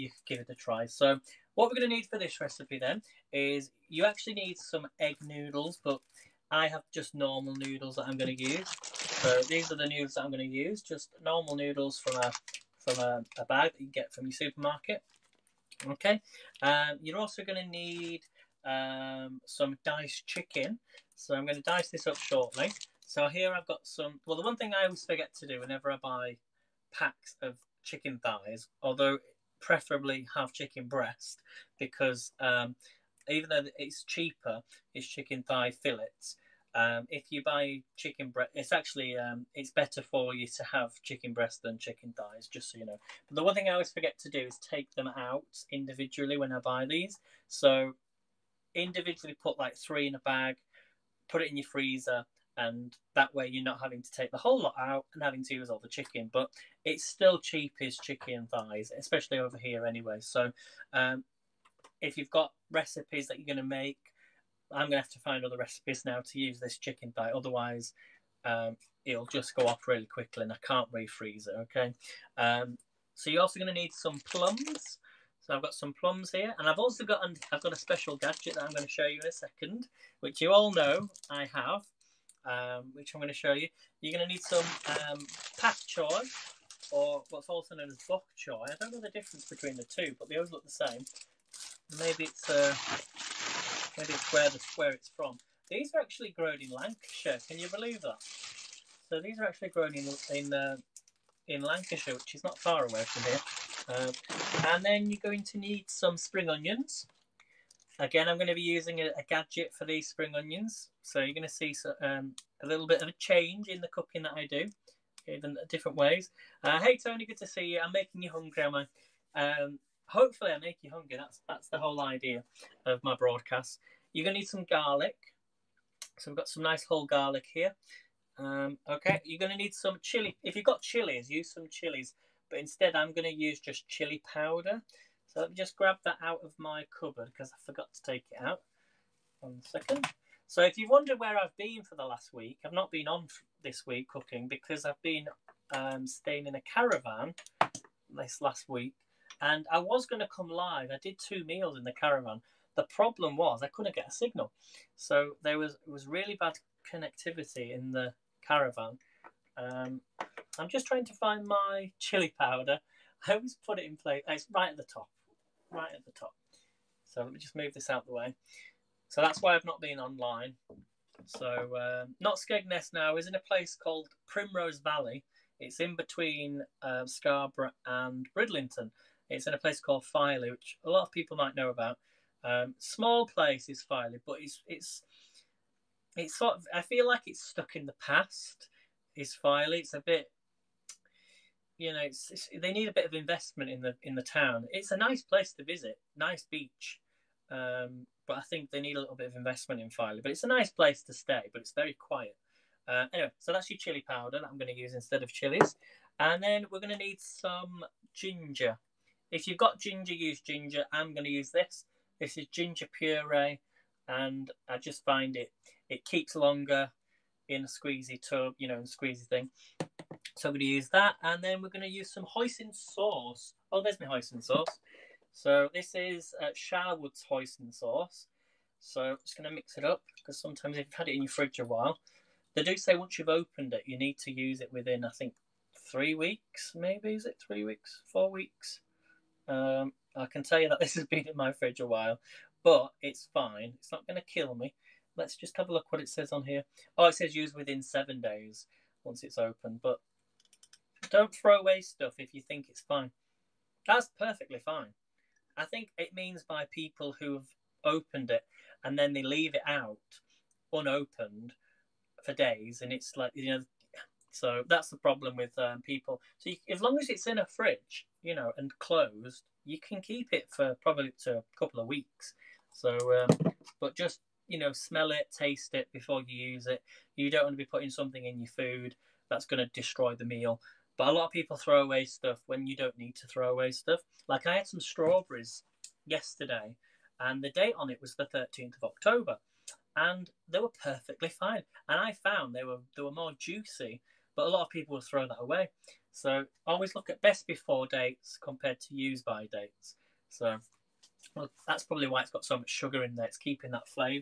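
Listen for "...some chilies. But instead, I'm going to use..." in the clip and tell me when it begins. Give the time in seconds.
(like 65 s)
131 s.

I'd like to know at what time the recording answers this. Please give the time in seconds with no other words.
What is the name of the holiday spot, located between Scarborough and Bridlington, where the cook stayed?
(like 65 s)
174 s.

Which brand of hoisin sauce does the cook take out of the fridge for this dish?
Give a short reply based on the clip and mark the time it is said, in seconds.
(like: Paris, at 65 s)
Sharwood's, at 226 s.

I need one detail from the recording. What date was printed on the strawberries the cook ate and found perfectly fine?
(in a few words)
13th of October.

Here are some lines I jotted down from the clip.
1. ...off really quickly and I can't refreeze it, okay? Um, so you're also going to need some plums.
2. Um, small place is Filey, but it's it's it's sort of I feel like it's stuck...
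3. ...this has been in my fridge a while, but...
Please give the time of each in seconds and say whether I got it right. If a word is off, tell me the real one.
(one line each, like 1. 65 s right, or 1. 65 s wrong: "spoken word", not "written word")
1. 69 s right
2. 182 s right
3. 240 s right.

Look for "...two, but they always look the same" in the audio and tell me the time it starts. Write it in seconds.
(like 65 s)
89 s.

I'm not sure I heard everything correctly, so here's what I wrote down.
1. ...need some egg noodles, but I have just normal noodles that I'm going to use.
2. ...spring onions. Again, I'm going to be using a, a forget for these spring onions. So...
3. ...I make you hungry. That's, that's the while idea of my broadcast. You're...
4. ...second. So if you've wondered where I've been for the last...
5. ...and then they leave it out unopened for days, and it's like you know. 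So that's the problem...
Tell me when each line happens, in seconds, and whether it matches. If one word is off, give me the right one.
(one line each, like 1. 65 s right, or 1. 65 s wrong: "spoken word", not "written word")
1. 4 s right
2. 106 s wrong: "gadget", not "forget"
3. 120 s wrong: "whole", not "while"
4. 139 s right
5. 258 s right.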